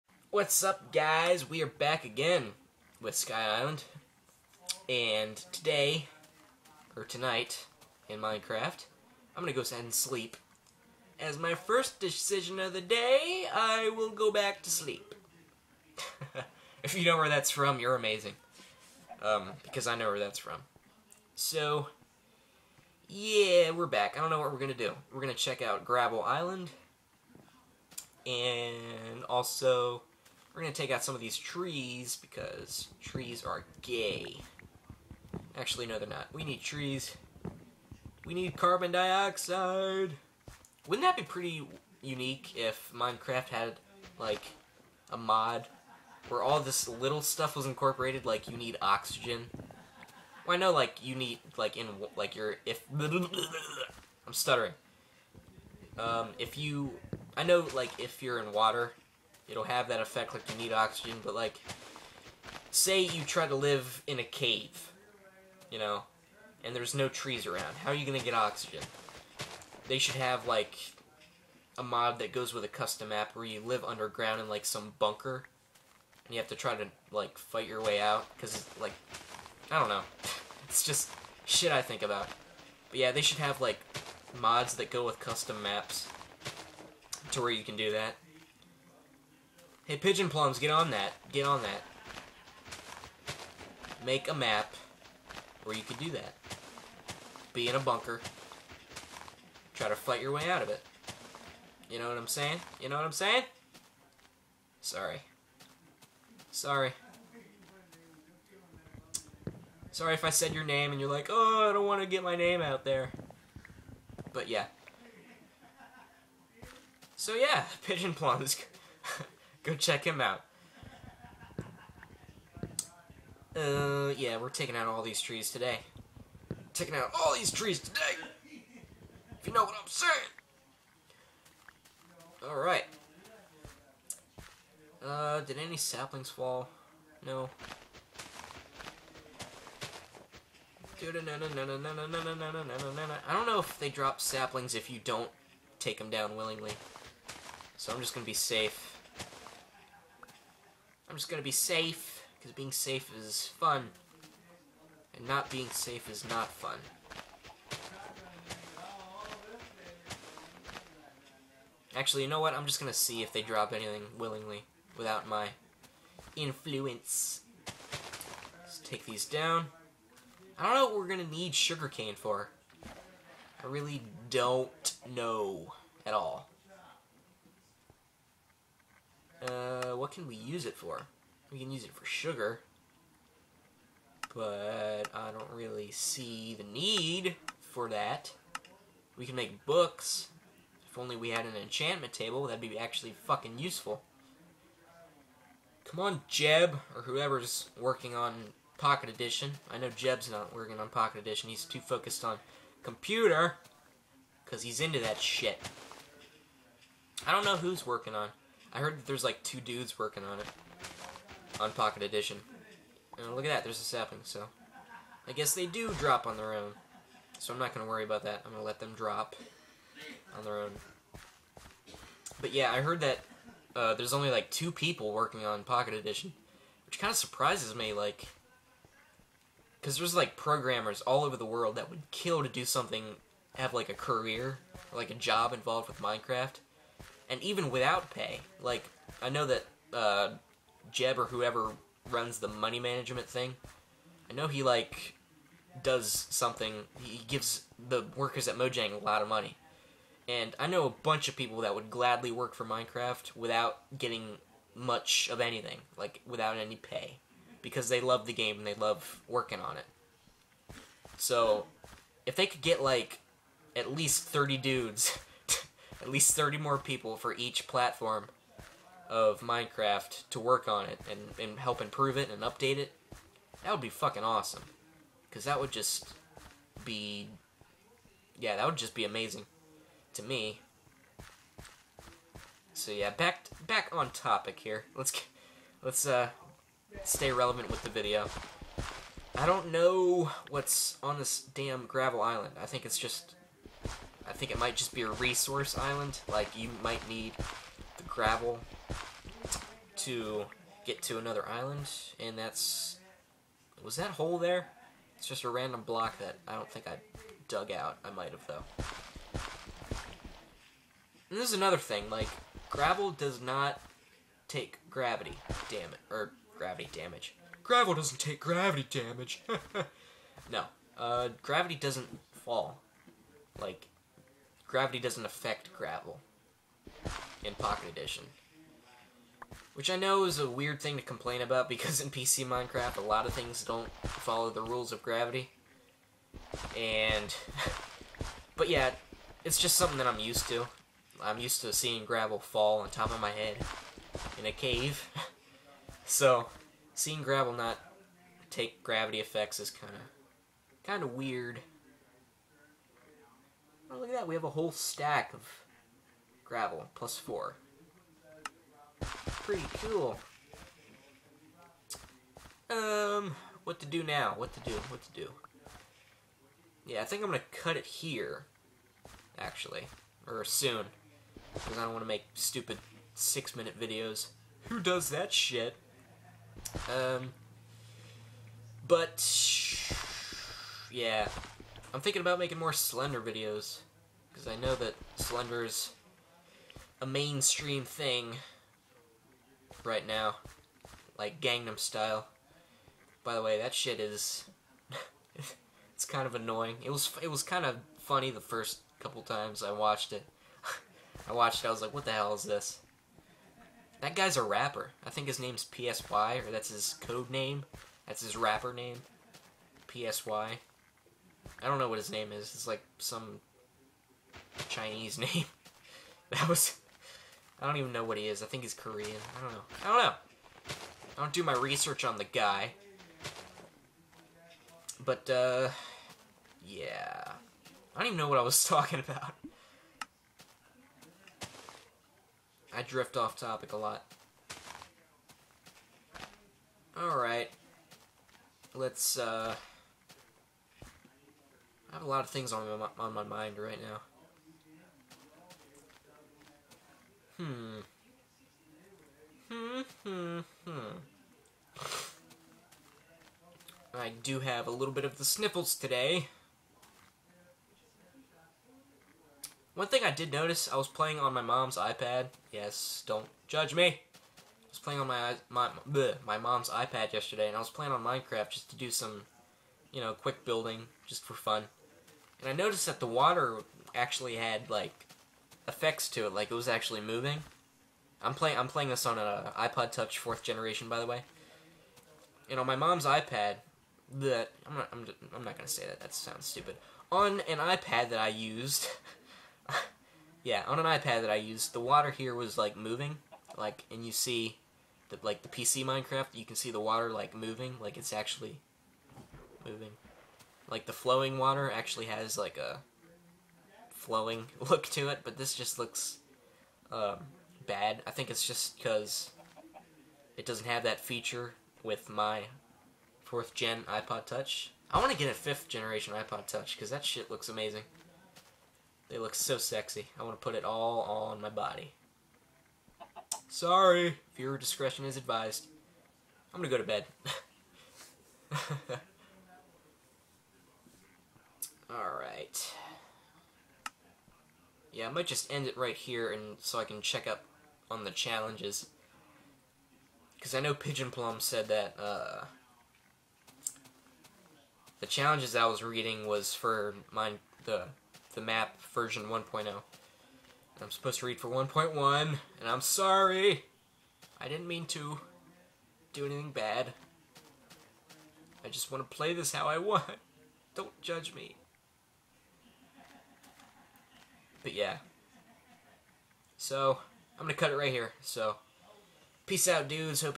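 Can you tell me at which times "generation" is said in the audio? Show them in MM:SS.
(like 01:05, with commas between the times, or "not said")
08:00, 08:35.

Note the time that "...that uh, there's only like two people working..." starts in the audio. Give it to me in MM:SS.
03:43.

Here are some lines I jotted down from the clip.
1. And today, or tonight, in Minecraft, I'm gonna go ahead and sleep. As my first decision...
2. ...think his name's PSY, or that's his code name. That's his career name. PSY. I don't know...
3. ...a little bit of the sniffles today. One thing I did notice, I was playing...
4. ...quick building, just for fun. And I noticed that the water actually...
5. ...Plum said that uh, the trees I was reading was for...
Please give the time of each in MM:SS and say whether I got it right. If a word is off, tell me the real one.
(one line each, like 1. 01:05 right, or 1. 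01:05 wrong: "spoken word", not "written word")
1. 00:04 right
2. 06:45 wrong: "rapper", not "career"
3. 07:34 right
4. 07:50 right
5. 09:01 wrong: "challenges", not "trees".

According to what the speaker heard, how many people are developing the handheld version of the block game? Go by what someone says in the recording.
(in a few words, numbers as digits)
2.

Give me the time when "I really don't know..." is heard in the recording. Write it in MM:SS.
02:53.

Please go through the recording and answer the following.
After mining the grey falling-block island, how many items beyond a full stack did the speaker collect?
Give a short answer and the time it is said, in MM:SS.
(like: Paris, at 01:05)
4, at 05:56.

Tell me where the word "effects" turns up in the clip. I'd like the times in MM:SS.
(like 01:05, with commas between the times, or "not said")
01:00, 05:49, 07:55.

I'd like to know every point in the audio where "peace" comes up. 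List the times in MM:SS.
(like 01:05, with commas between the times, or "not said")
09:29.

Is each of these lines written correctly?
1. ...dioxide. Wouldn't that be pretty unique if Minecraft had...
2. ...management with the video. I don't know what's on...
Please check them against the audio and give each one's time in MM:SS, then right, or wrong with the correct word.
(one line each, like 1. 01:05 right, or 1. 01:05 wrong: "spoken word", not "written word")
1. 00:38 right
2. 04:47 wrong: "relevant", not "management".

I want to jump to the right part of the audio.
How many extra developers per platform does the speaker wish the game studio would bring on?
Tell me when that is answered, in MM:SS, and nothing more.
04:26.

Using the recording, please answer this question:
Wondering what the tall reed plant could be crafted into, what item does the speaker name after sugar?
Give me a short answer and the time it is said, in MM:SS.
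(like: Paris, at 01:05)
Books, at 03:09.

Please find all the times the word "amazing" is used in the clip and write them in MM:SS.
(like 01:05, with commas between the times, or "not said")
00:17, 04:39, 08:37.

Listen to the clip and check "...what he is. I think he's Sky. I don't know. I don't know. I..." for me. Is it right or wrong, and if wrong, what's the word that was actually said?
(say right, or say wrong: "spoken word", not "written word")
wrong: "Korean", not "Sky".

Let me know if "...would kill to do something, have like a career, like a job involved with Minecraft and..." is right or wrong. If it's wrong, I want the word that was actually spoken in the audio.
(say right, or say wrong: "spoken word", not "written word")
right.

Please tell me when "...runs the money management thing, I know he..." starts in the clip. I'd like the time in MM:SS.
04:02.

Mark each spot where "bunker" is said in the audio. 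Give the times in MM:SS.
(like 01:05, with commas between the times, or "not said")
01:14, 01:37.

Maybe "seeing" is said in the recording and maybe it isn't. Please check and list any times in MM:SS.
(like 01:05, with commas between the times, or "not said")
05:41, 05:46.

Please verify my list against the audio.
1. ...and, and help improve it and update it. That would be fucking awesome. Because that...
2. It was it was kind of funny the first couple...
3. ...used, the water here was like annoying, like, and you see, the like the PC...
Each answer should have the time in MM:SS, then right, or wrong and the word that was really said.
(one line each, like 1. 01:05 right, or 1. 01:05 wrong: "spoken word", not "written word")
1. 04:31 right
2. 06:36 right
3. 08:11 wrong: "moving", not "annoying".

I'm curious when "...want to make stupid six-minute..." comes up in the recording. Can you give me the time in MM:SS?
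06:11.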